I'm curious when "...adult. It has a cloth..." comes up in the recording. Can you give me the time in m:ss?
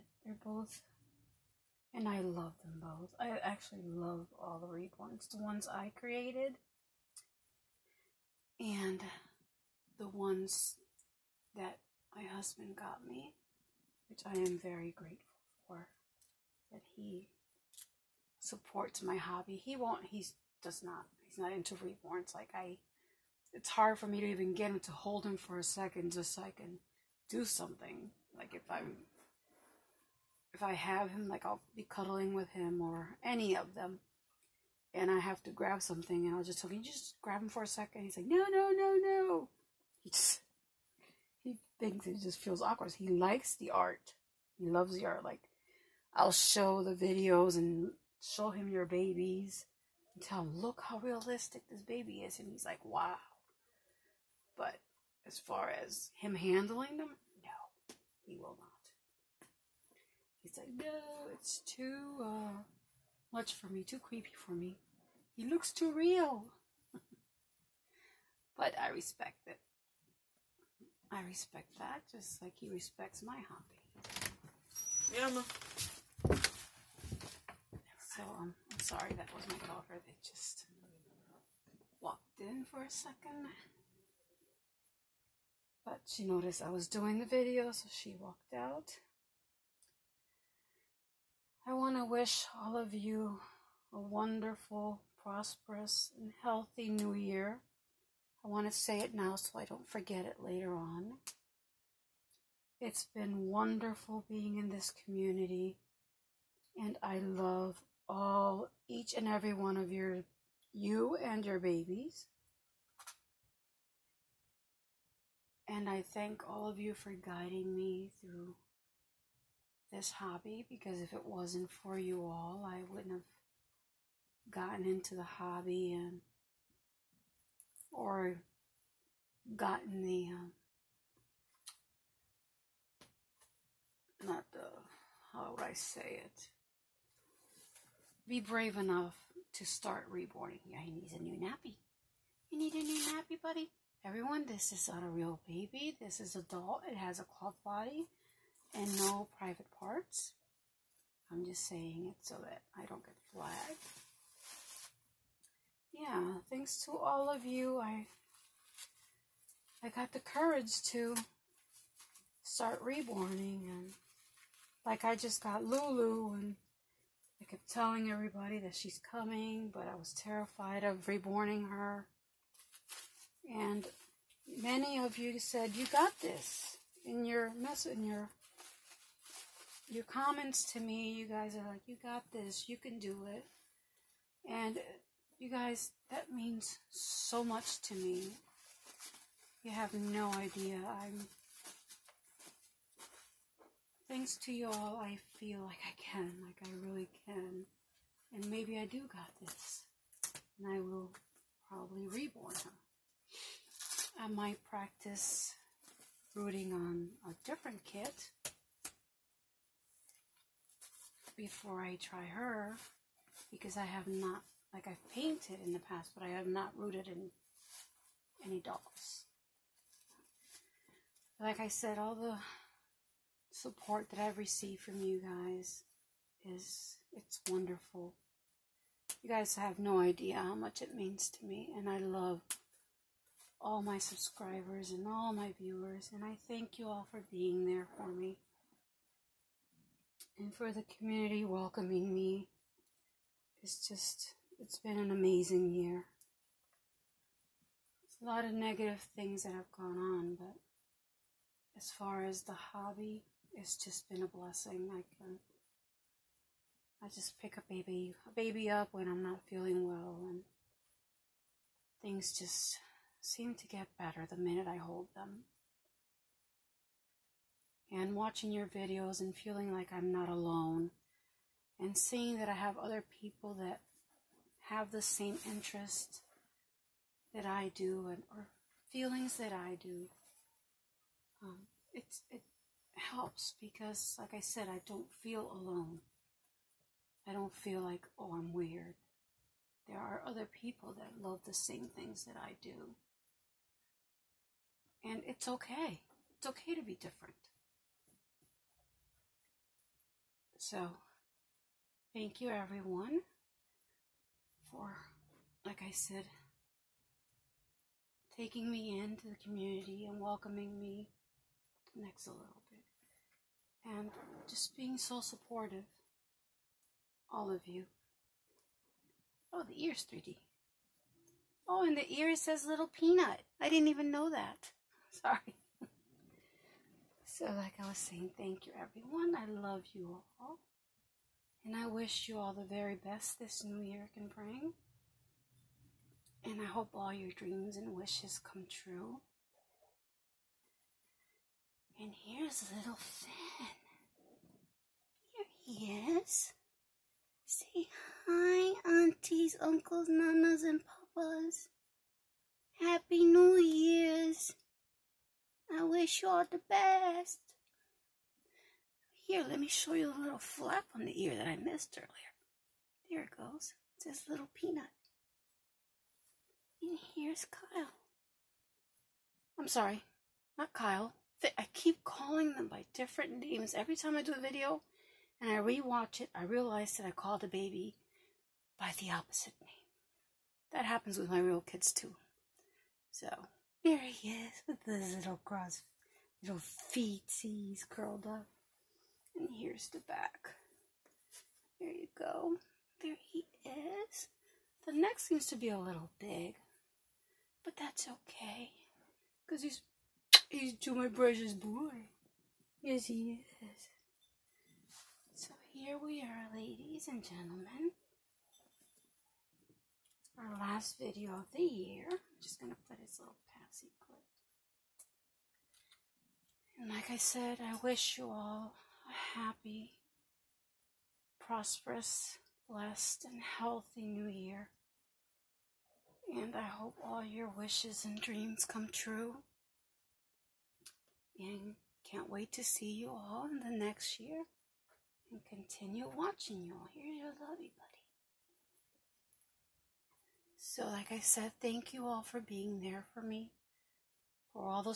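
2:26.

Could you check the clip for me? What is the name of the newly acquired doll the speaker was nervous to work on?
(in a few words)
Lulu.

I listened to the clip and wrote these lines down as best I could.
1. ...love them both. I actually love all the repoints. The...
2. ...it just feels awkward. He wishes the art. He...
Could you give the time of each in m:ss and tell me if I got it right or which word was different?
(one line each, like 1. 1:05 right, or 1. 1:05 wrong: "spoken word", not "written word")
1. 0:02 right
2. 0:42 wrong: "likes", not "wishes".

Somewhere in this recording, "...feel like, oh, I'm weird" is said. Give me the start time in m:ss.
4:47.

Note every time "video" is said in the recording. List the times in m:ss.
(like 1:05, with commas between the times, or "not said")
0:46, 1:27, 4:28, 6:14, 6:50.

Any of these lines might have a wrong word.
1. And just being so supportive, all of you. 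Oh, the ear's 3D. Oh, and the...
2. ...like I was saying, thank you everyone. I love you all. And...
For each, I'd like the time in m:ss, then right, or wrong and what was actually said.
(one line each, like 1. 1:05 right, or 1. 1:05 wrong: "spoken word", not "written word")
1. 5:13 right
2. 5:27 right.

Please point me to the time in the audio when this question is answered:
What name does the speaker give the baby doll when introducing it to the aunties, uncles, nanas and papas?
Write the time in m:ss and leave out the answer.
5:42.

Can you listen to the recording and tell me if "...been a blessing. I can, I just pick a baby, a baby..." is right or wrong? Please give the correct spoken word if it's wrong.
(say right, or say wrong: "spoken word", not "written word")
right.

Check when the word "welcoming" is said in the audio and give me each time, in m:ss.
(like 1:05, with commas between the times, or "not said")
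4:01, 5:10.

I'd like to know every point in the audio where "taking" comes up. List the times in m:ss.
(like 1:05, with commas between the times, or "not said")
5:08.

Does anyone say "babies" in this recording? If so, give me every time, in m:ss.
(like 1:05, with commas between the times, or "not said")
0:48, 1:51.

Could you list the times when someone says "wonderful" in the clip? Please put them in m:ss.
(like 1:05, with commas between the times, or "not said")
1:33, 1:43, 3:47.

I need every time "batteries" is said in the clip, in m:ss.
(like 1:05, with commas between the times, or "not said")
not said.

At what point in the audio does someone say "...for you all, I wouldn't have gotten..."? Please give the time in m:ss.
2:01.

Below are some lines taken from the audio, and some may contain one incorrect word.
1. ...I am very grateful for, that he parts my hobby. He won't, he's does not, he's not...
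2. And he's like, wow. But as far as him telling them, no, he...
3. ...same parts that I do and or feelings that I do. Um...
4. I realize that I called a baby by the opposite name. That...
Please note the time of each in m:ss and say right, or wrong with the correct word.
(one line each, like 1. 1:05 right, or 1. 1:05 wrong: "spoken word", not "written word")
1. 0:14 wrong: "supports", not "parts"
2. 0:52 wrong: "handling", not "telling"
3. 4:35 wrong: "interests", not "parts"
4. 6:16 right.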